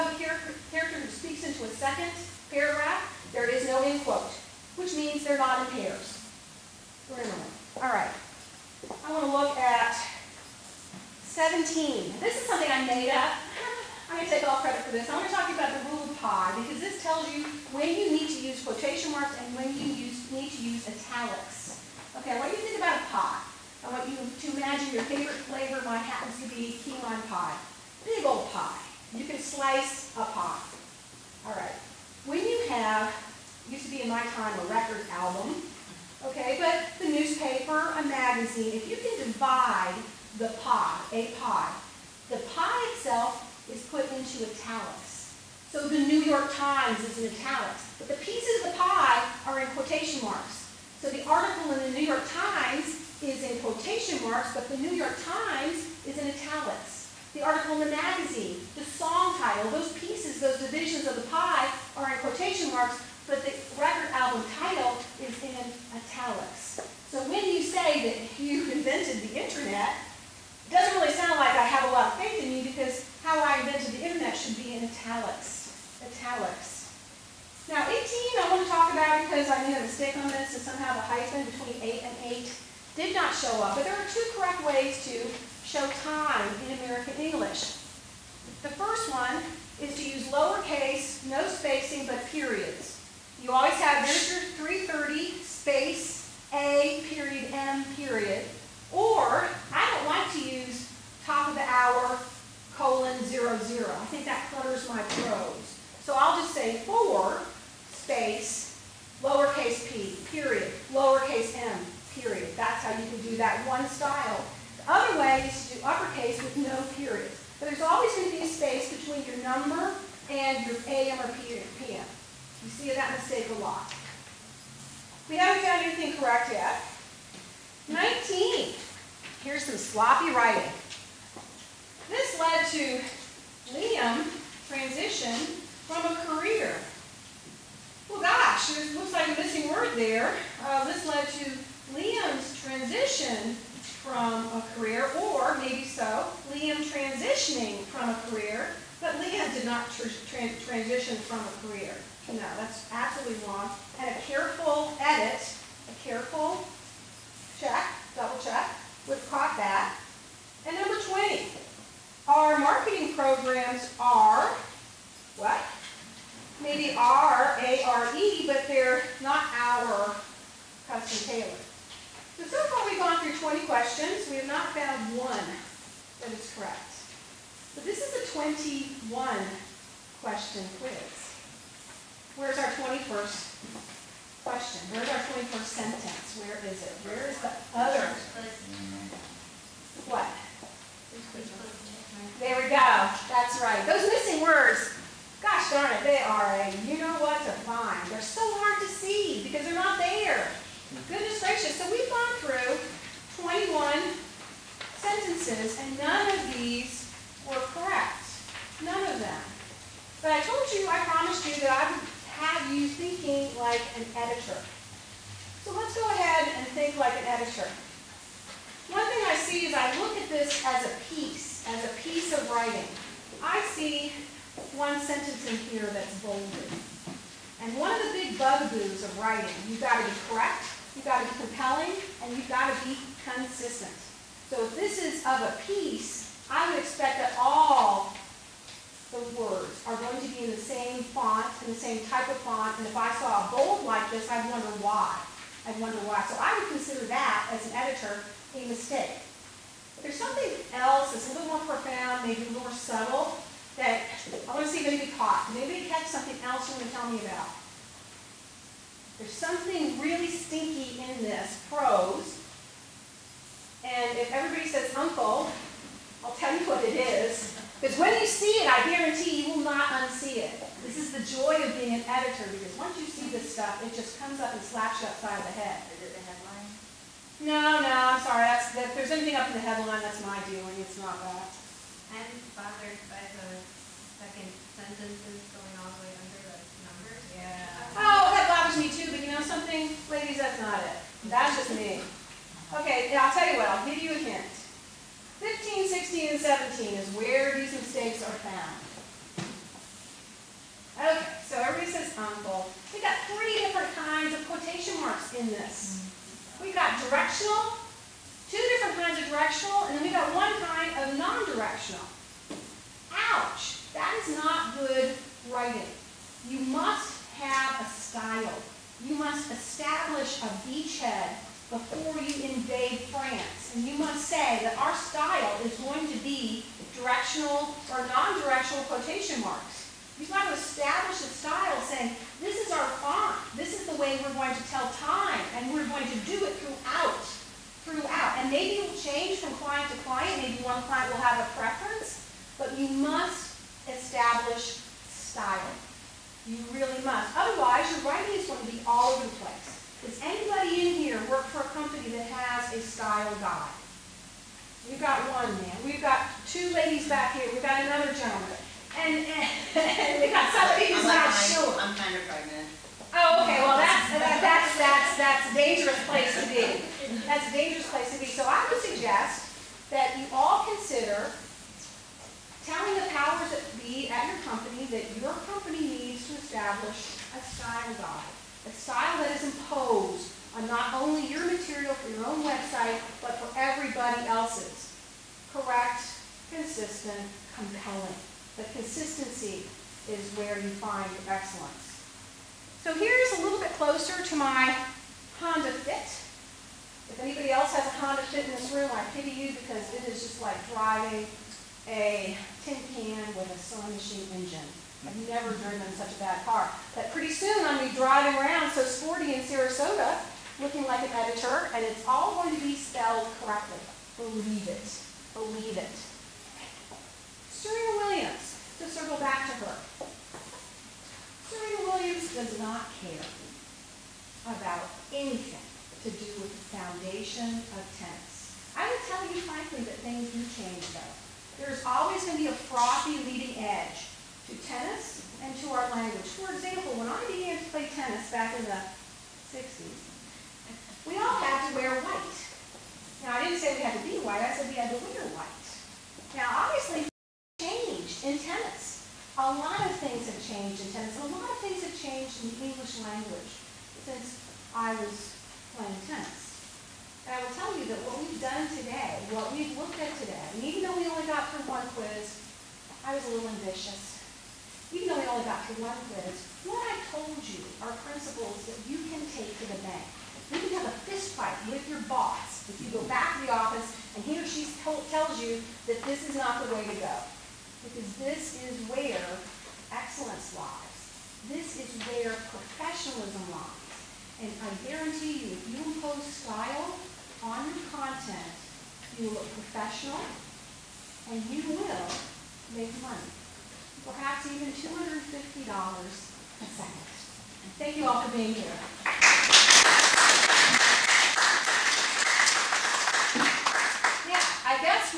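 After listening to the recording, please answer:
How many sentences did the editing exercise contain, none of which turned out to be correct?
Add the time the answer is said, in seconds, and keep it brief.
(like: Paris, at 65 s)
21, at 203 s.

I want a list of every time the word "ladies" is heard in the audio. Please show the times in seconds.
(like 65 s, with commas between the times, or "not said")
290 s, 356 s.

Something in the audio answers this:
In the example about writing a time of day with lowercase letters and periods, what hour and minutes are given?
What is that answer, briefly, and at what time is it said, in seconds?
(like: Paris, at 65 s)
3:30, at 94 s.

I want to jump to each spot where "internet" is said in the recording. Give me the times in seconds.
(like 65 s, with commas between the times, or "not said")
69 s, 74 s.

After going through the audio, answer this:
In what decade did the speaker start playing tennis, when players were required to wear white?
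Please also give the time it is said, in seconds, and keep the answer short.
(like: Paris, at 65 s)
1960s, at 438 s.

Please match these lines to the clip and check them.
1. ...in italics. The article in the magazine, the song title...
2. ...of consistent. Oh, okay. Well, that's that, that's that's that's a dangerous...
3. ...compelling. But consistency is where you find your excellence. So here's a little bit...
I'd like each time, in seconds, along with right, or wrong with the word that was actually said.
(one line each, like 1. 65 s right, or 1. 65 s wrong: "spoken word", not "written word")
1. 56 s right
2. 362 s wrong: "pregnant", not "consistent"
3. 387 s right.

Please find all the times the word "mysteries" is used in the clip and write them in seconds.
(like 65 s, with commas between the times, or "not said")
not said.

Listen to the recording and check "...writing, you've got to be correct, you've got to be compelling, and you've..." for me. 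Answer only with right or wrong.
right.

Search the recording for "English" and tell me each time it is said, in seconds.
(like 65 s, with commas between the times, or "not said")
87 s, 452 s.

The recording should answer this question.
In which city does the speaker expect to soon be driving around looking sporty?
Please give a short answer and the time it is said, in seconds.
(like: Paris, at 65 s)
Sarasota, at 409 s.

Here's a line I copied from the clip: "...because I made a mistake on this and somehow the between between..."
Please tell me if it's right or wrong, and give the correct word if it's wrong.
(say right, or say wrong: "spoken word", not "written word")
wrong: "hyphen", not "between".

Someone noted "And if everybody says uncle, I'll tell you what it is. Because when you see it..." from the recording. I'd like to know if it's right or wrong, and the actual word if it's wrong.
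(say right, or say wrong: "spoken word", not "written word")
right.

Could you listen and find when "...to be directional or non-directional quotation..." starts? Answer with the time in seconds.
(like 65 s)
326 s.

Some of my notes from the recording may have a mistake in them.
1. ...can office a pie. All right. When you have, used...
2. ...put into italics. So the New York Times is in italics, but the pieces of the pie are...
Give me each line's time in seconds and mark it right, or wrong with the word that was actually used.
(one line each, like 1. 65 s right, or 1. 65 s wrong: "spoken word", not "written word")
1. 29 s wrong: "slice", not "office"
2. 43 s right.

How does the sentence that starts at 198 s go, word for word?
They're so hard to see because they're not there.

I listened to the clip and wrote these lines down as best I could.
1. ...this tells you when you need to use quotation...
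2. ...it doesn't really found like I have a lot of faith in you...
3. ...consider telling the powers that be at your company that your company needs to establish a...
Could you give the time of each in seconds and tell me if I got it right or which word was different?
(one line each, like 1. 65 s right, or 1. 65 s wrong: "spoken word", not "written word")
1. 16 s right
2. 70 s wrong: "sound", not "found"
3. 370 s right.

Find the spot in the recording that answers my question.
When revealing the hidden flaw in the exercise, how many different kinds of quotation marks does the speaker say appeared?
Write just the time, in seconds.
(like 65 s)
303 s.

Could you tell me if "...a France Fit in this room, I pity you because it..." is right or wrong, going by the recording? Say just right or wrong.
wrong.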